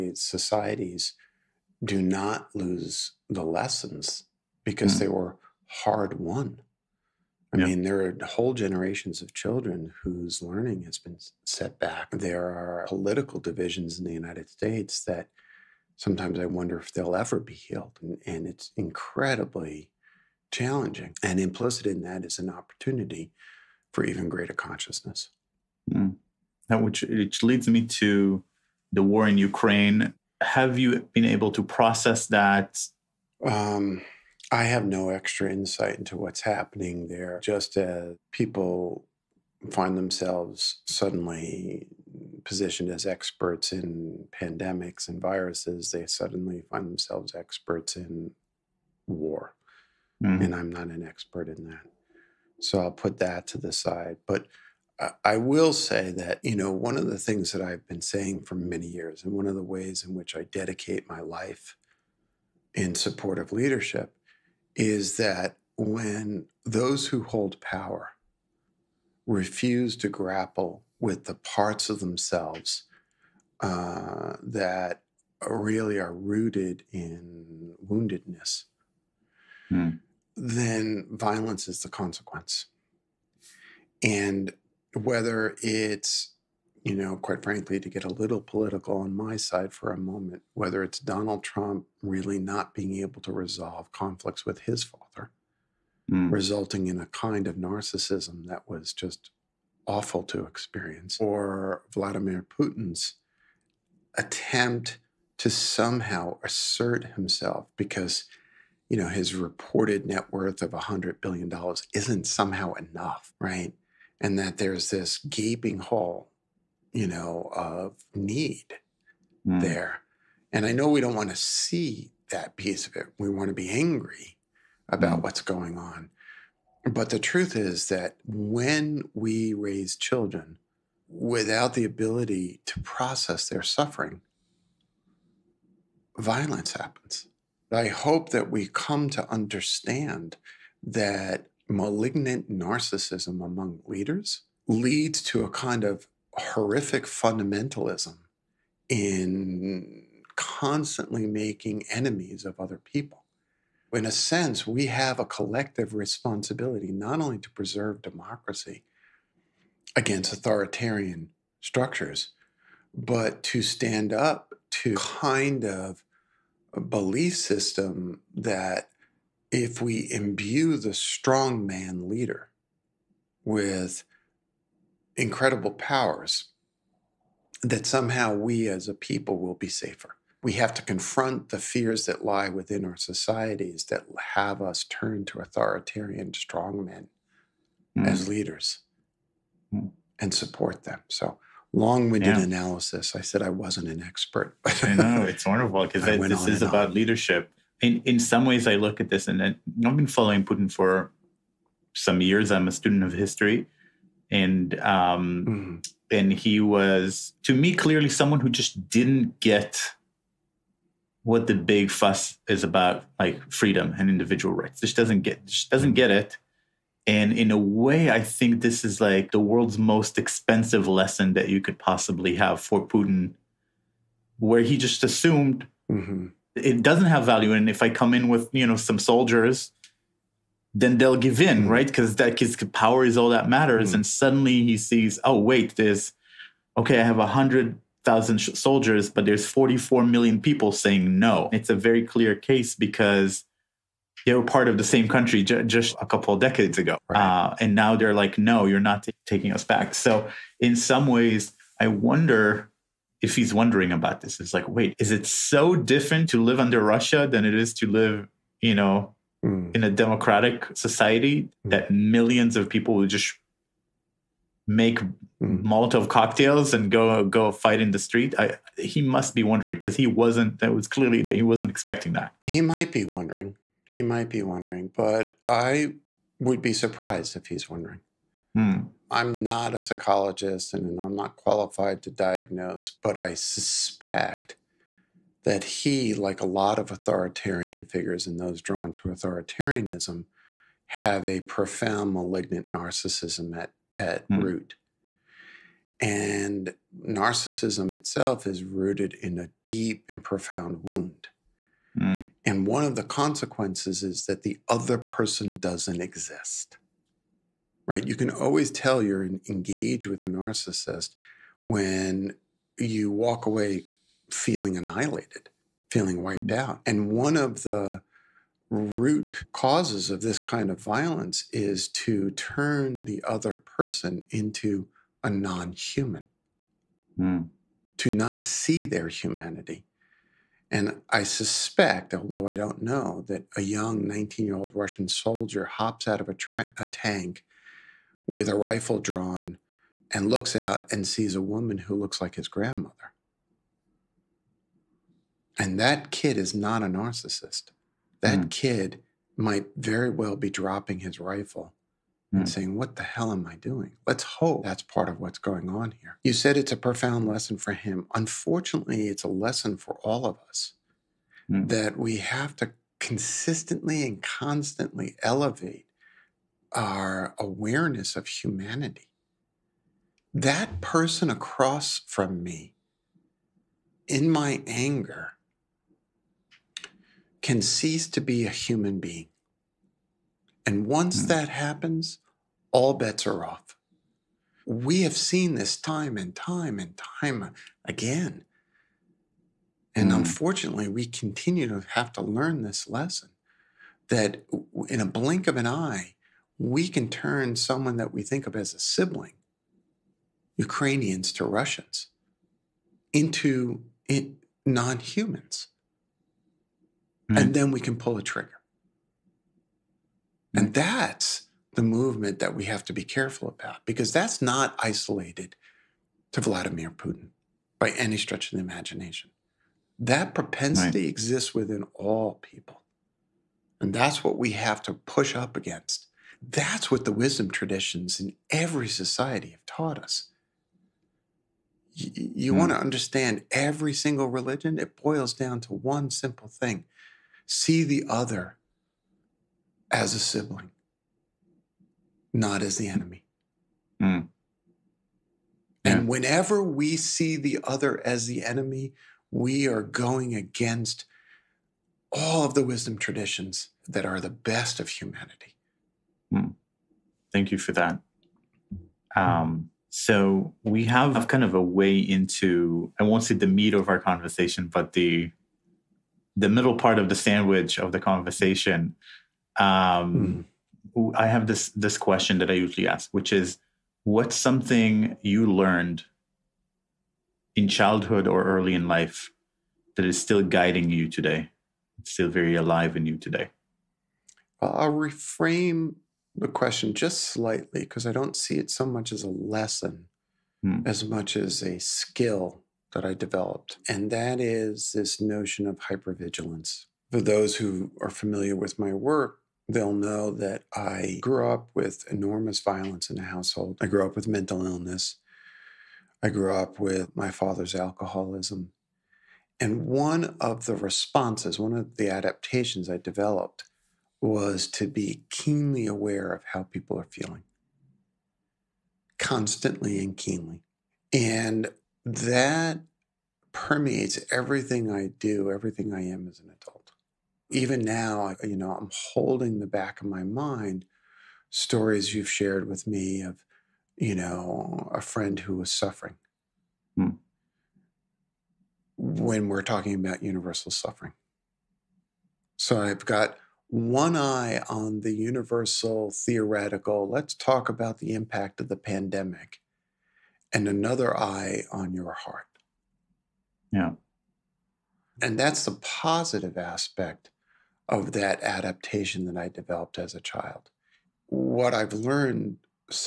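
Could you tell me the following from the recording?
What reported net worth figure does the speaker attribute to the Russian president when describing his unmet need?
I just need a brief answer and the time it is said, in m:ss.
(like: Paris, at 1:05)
$100 billion, at 1:50.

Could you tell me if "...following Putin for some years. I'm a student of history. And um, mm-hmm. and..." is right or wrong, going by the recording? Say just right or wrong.
right.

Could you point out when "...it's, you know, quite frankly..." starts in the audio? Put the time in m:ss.
1:25.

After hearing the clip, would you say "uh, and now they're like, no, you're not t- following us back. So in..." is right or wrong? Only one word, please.
wrong.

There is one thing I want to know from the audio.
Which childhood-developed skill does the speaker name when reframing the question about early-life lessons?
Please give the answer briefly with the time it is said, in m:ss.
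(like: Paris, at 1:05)
Hypervigilance, at 8:15.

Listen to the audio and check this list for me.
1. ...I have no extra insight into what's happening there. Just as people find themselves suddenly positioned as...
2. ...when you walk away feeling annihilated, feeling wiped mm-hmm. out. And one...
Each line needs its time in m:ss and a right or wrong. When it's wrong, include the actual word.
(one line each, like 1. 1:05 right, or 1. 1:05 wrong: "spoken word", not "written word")
1. 0:34 right
2. 5:11 right.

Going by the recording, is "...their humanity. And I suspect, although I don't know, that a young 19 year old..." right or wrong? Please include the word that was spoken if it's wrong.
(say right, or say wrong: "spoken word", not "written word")
right.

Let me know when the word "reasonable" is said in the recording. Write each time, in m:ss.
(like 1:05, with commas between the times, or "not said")
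not said.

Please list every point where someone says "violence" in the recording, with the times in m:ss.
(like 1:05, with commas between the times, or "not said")
1:21, 2:16, 5:20, 8:22.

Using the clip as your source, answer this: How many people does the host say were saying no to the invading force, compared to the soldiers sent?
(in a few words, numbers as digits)
44 million.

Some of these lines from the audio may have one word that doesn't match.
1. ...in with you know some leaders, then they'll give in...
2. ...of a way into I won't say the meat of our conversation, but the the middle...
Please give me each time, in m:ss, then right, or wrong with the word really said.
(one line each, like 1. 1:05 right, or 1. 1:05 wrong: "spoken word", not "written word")
1. 3:48 wrong: "soldiers", not "leaders"
2. 7:41 right.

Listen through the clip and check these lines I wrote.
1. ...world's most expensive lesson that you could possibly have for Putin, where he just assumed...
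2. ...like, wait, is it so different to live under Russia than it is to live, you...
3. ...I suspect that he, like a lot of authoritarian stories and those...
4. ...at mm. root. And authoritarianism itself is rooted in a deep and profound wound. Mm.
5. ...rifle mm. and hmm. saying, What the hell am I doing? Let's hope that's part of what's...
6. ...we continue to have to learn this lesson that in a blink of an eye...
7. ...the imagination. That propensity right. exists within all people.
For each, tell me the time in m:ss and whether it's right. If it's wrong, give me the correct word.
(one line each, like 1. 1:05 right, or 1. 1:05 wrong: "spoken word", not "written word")
1. 3:39 right
2. 4:14 right
3. 4:43 wrong: "figures", not "stories"
4. 4:53 wrong: "narcissism", not "authoritarianism"
5. 5:51 right
6. 6:30 right
7. 6:58 right.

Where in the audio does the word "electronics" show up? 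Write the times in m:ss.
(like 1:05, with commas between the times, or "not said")
not said.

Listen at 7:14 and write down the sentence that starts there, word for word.
It boils down to one simple thing see the other as a sibling, not as the enemy.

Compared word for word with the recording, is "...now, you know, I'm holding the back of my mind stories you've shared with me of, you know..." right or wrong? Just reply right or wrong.
right.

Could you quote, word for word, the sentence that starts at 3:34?
Just doesn't get just doesn't mm-hmm.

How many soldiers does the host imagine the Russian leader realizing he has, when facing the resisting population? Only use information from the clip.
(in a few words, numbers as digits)
100,000.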